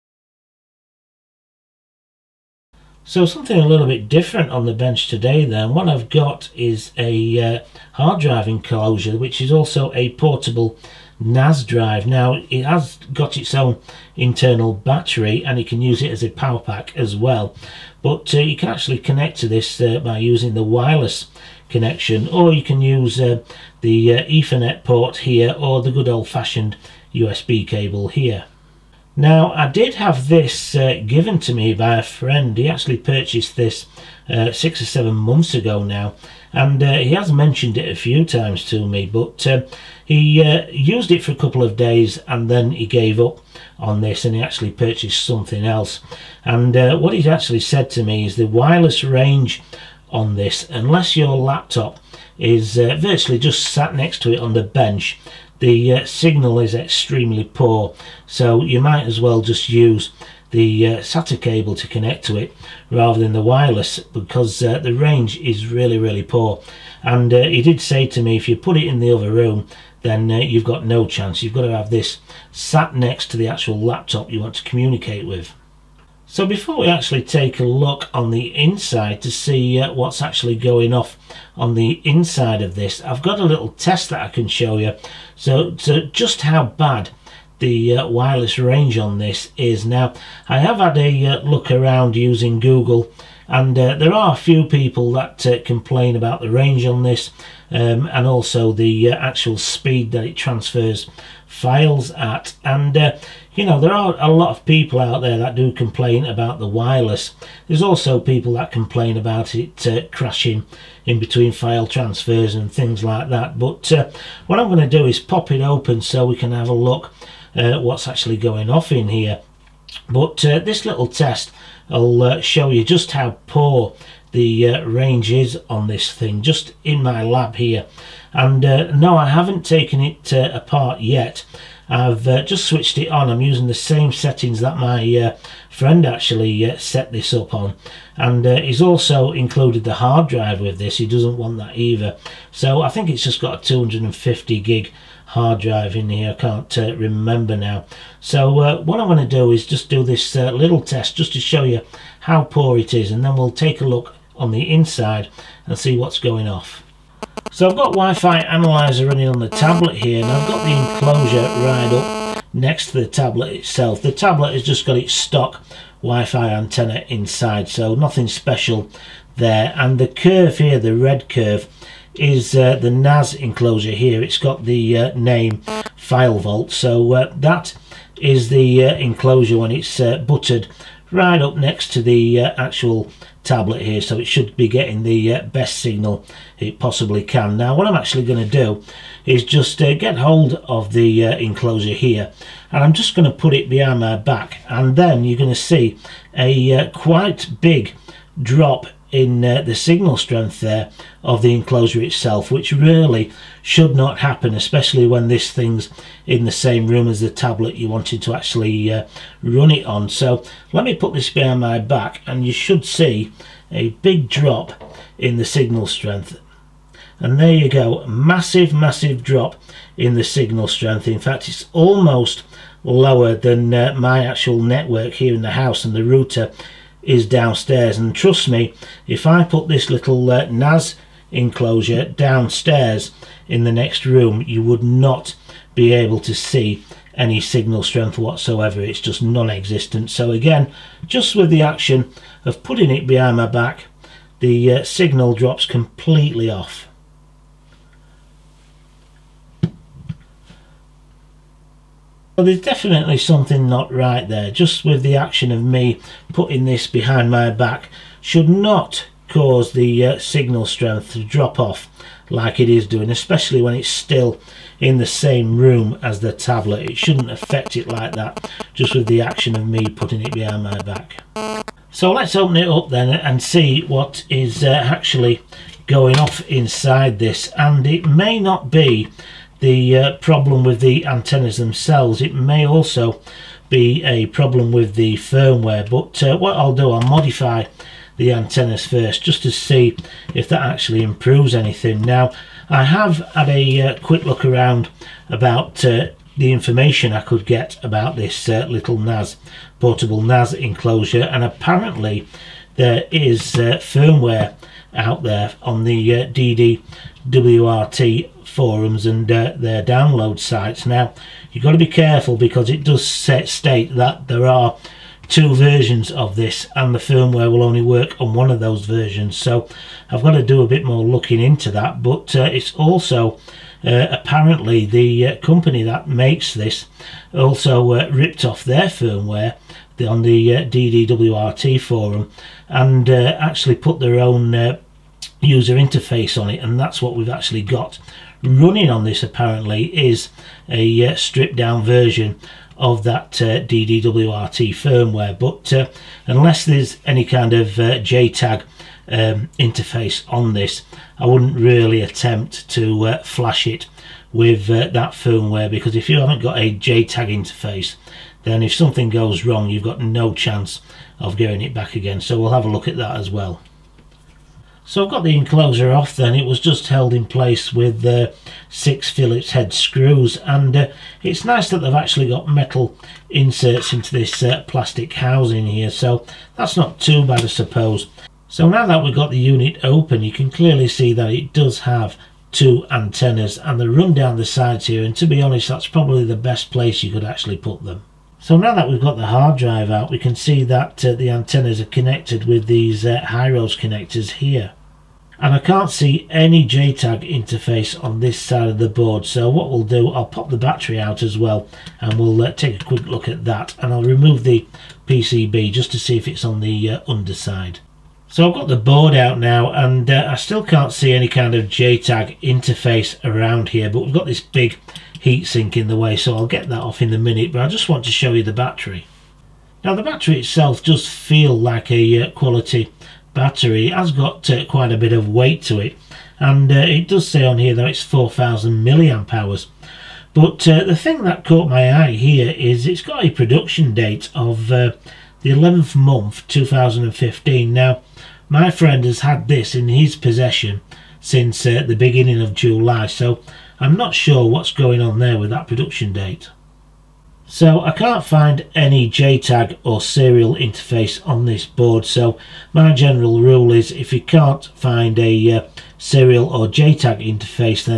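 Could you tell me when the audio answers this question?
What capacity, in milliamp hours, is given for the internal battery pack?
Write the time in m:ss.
7:08.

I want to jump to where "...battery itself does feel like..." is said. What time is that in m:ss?
7:00.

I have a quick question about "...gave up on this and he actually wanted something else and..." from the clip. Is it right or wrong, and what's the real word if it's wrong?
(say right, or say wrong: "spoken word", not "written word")
wrong: "purchased", not "wanted".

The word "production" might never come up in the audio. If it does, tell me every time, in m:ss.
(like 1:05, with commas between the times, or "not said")
7:13, 7:25.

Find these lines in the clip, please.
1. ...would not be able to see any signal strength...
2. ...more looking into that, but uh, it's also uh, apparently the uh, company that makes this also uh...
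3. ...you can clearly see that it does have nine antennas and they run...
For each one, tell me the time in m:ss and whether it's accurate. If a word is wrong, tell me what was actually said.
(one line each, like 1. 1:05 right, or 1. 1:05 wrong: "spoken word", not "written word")
1. 3:54 right
2. 5:20 right
3. 6:20 wrong: "two", not "nine".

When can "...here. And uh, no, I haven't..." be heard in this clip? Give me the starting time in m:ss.
2:07.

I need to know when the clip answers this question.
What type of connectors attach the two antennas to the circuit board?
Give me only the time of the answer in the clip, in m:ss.
6:33.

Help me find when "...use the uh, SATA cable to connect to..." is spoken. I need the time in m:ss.
0:59.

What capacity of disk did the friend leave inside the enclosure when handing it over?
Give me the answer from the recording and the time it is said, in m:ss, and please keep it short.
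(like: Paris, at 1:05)
250 gig, at 2:23.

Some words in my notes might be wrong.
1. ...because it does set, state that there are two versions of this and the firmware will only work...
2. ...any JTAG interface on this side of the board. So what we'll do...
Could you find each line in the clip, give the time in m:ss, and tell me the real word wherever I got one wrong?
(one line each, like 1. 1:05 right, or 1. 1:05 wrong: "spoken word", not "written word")
1. 5:12 right
2. 6:36 right.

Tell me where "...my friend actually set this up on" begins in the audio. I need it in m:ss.
2:14.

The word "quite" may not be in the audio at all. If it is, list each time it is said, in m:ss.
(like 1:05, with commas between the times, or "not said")
3:16, 7:04.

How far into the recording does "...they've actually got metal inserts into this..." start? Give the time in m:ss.
6:11.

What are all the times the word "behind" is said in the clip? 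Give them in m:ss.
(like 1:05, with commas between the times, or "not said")
3:13, 3:31, 4:03, 4:16, 4:30.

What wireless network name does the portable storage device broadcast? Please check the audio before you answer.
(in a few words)
File Vault.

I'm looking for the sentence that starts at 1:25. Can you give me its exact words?
So, so just how bad the uh, wireless range on this is.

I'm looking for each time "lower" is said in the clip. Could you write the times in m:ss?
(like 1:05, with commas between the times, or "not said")
3:42.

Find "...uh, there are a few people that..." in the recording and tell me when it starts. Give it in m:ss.
1:33.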